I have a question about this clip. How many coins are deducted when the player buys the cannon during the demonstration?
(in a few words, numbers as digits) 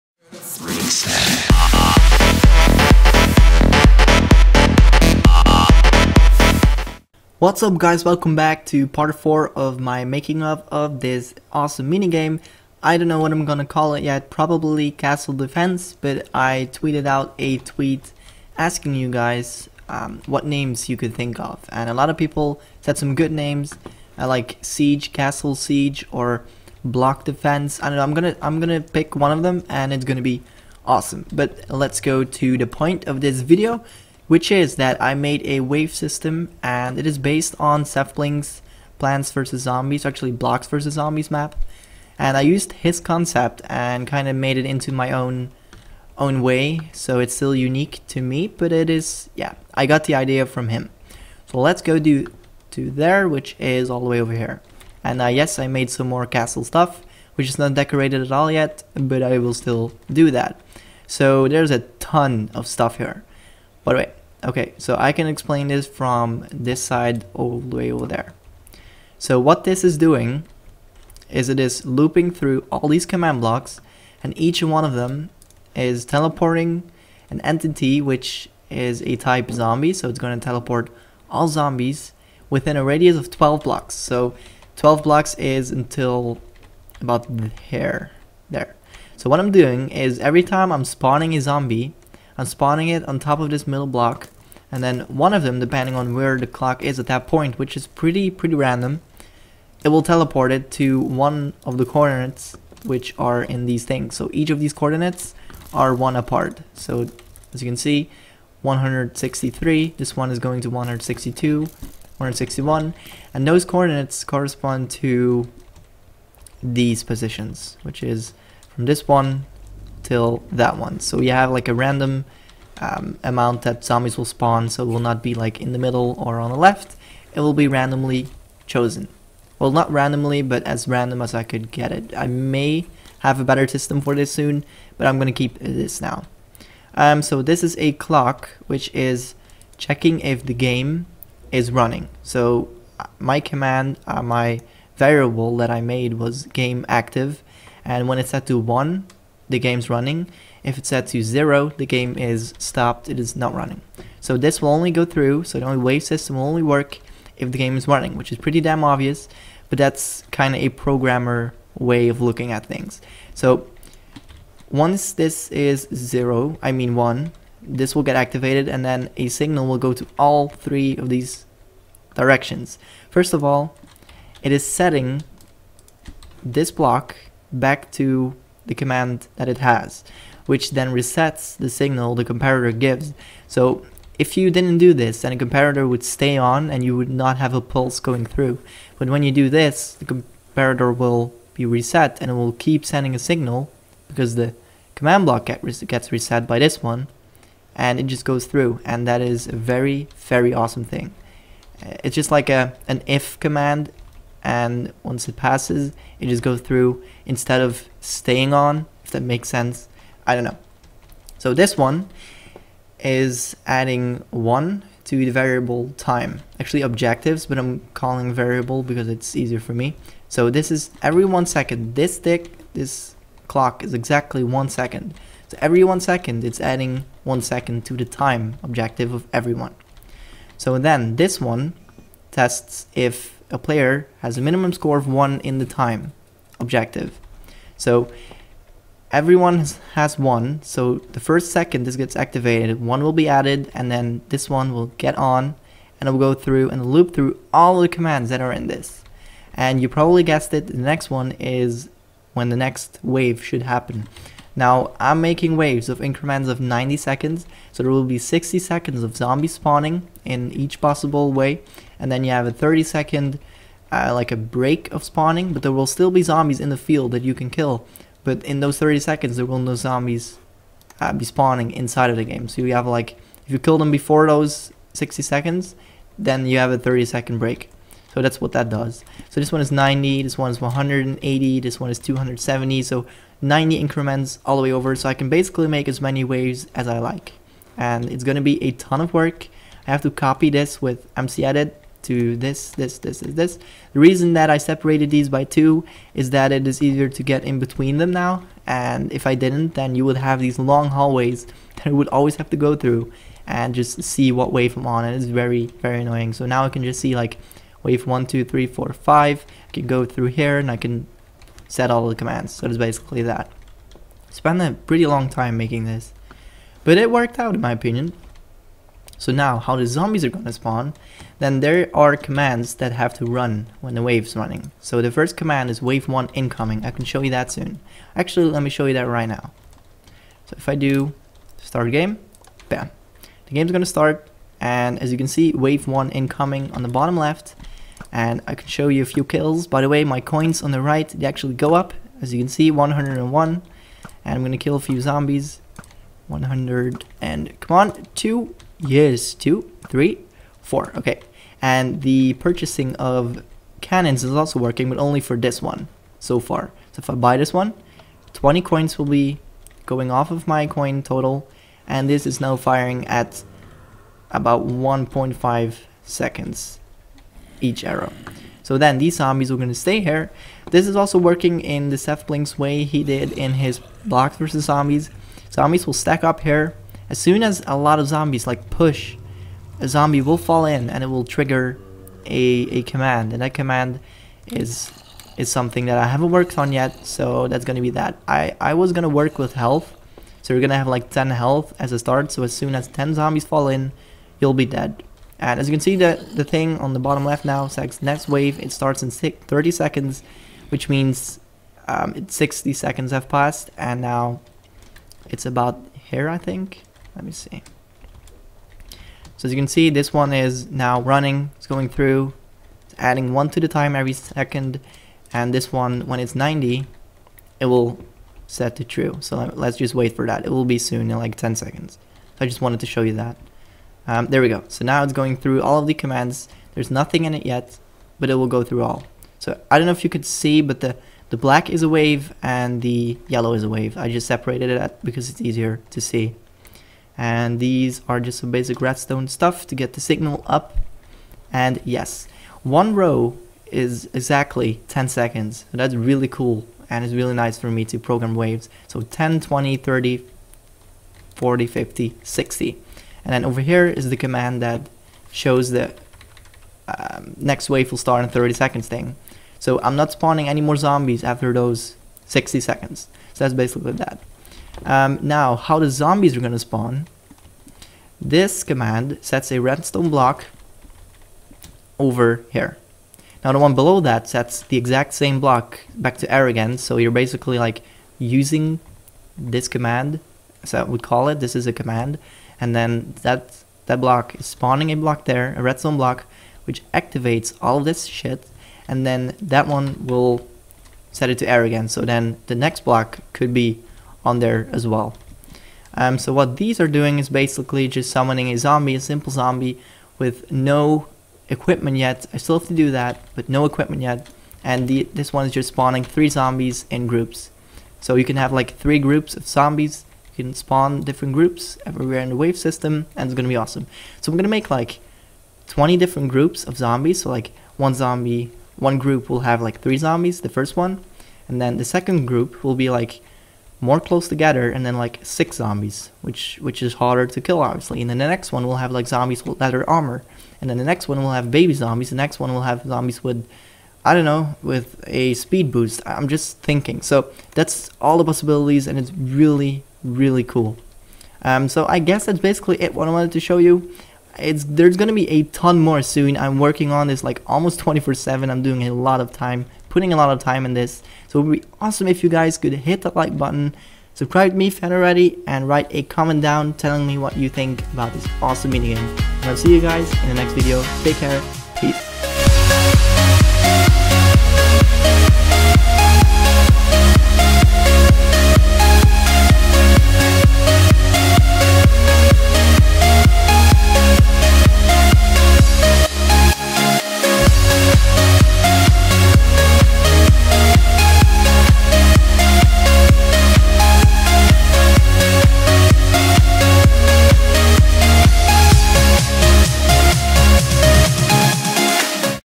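20.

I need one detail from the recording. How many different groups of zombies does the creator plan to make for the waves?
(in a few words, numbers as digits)
20.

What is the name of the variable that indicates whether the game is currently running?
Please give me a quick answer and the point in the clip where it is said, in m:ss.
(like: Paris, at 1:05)
game active, at 2:26.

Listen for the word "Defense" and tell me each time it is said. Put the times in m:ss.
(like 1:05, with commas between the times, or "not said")
0:15, 0:27.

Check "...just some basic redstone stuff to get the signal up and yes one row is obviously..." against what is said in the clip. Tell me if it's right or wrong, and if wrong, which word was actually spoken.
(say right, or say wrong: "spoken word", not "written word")
wrong: "exactly", not "obviously".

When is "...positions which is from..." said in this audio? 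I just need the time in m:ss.
1:57.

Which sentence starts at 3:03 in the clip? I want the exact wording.
So if you didn't do this, then a comparator would stay on and you would not have a pulse going through.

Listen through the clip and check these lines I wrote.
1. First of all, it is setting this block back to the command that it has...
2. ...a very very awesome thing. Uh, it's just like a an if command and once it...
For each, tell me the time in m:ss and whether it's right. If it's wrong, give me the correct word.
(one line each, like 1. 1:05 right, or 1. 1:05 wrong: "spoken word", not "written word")
1. 2:53 right
2. 3:19 right.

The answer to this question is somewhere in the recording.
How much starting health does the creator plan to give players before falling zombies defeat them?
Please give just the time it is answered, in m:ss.
6:31.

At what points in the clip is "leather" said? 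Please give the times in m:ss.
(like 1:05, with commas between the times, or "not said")
8:49.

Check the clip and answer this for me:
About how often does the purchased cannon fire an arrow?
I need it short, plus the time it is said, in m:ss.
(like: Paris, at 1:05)
1.5 seconds, at 6:04.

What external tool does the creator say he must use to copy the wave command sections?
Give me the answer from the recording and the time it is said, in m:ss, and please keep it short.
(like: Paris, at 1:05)
MC Edit, at 4:51.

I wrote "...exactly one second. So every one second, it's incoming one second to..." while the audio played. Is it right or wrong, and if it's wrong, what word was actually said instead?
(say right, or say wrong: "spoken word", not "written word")
wrong: "adding", not "incoming".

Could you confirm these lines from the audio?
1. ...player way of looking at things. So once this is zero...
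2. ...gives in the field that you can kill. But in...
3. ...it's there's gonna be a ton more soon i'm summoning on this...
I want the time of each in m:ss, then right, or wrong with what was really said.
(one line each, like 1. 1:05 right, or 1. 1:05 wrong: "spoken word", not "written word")
1. 2:40 wrong: "programmer", not "player"
2. 4:26 wrong: "zombies", not "gives"
3. 9:04 wrong: "working", not "summoning".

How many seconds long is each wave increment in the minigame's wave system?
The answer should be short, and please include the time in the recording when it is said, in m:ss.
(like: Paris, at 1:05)
90, at 4:16.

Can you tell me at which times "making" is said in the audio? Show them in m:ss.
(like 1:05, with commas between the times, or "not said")
0:10, 4:15, 5:15.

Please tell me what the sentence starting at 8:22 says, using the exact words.
I still have to do that, but no equipment yet.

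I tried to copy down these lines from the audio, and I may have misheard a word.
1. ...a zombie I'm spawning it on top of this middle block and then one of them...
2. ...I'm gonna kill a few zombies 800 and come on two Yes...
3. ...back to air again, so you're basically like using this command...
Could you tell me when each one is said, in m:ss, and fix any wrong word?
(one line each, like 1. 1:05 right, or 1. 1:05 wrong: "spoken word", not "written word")
1. 1:31 right
2. 5:44 wrong: "100", not "800"
3. 7:55 right.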